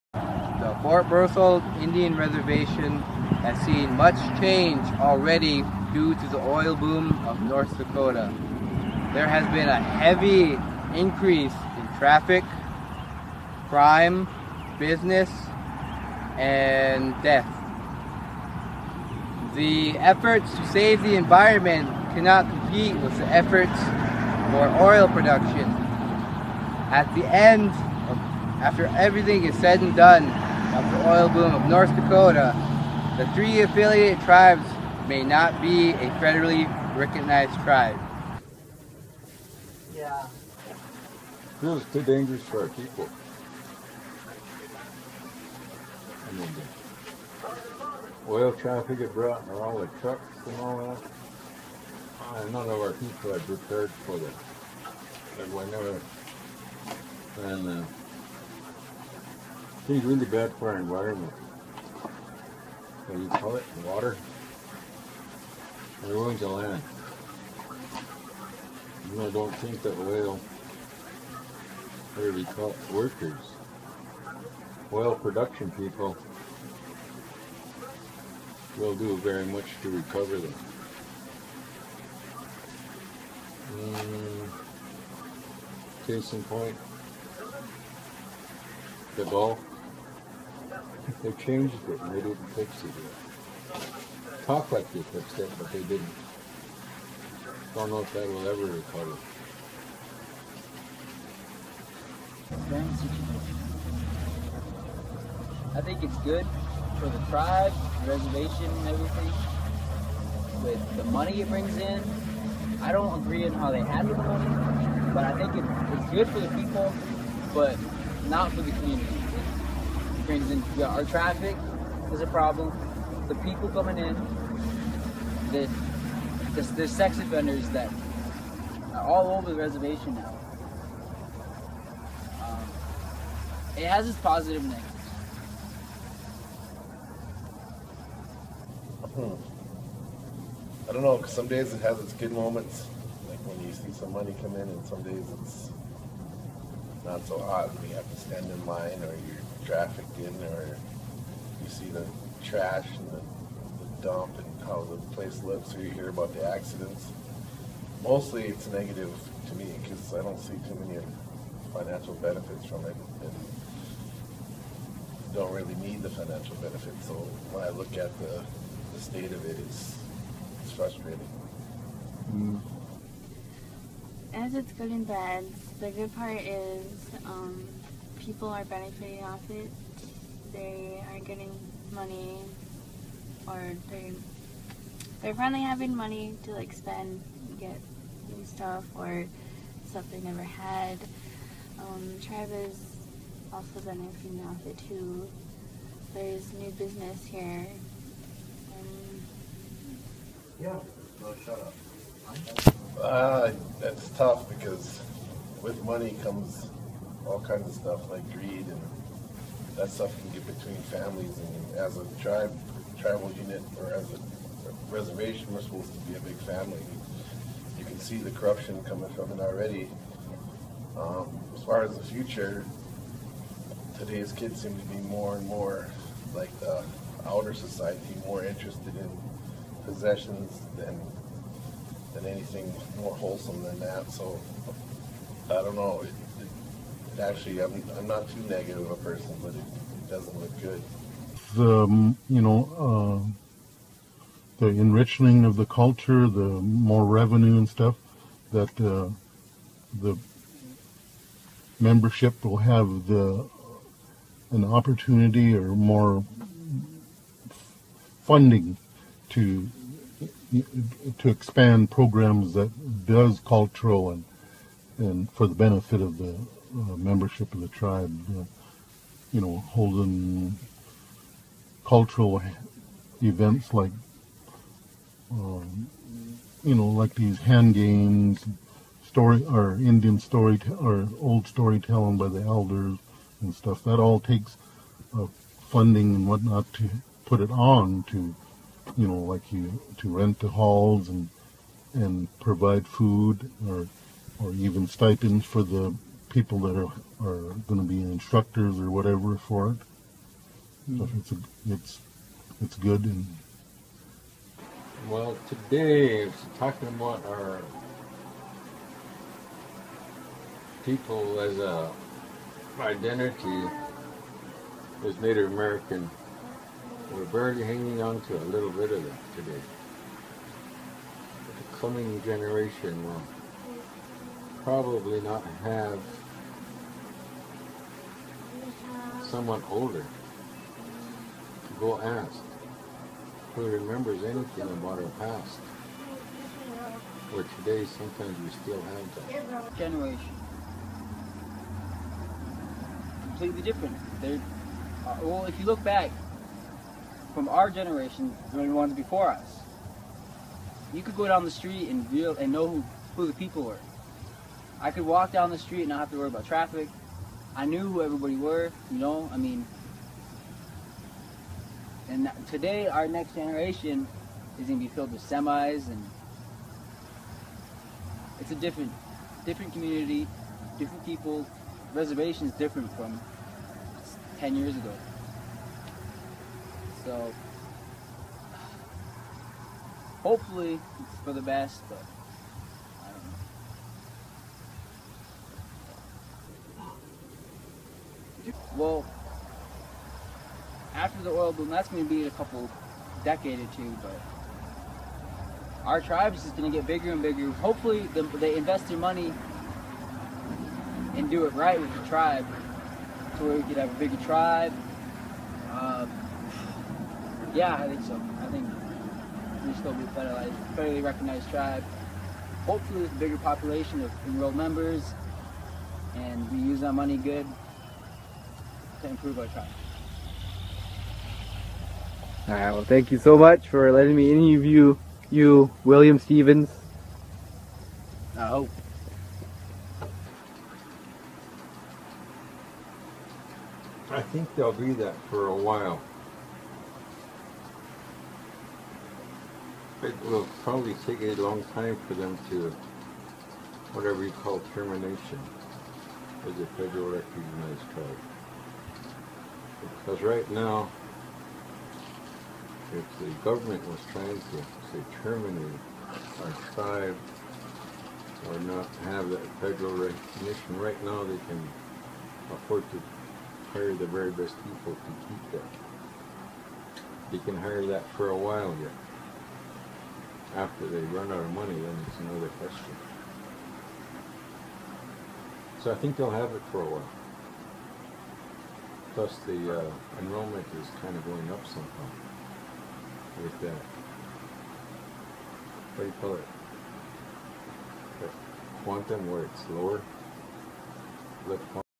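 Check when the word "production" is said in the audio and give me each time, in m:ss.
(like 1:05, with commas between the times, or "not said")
0:25, 1:15.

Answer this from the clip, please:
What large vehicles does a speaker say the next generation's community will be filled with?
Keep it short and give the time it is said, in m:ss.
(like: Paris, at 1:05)
Semis, at 6:05.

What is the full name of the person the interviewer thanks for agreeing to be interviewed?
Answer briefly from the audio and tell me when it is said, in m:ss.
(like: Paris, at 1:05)
William Stevens, at 7:05.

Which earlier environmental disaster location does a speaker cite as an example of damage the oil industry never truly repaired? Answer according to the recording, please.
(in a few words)
The Gulf.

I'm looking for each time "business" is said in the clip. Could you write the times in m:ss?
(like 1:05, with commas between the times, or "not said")
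0:14, 3:16.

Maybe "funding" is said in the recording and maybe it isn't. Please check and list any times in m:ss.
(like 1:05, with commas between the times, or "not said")
4:18, 4:45.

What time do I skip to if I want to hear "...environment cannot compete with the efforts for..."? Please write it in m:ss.
0:21.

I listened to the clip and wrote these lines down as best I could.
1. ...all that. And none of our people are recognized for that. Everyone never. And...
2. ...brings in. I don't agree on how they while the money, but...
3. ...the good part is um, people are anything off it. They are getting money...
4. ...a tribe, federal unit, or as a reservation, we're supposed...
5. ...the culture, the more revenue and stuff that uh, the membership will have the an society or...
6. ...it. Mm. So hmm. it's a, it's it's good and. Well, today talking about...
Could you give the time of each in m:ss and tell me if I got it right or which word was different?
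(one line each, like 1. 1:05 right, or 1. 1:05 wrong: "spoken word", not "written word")
1. 0:50 wrong: "prepared", not "recognized"
2. 1:51 wrong: "handle", not "while"
3. 2:55 wrong: "benefiting", not "anything"
4. 3:31 wrong: "tribal", not "federal"
5. 4:05 wrong: "opportunity", not "society"
6. 4:59 right.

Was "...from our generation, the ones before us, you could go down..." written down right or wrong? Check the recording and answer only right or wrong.
right.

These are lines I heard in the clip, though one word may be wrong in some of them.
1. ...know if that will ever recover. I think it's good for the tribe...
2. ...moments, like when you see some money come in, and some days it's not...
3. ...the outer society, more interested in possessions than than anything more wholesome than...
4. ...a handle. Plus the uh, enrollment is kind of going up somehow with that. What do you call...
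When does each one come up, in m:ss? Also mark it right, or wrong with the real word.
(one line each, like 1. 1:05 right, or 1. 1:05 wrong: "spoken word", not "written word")
1. 1:37 right
2. 2:22 right
3. 3:46 right
4. 7:56 wrong: "while", not "handle".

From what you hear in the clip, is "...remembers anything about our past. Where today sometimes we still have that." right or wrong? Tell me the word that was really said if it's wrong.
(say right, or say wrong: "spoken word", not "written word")
right.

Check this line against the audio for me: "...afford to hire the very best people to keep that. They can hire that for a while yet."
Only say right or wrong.
right.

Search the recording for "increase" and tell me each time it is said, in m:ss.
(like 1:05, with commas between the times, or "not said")
0:10.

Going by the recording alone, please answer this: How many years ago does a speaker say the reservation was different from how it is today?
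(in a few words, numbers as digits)
10 years.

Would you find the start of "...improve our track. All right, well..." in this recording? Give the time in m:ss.
6:59.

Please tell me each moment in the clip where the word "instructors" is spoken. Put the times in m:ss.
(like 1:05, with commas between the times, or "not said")
4:58.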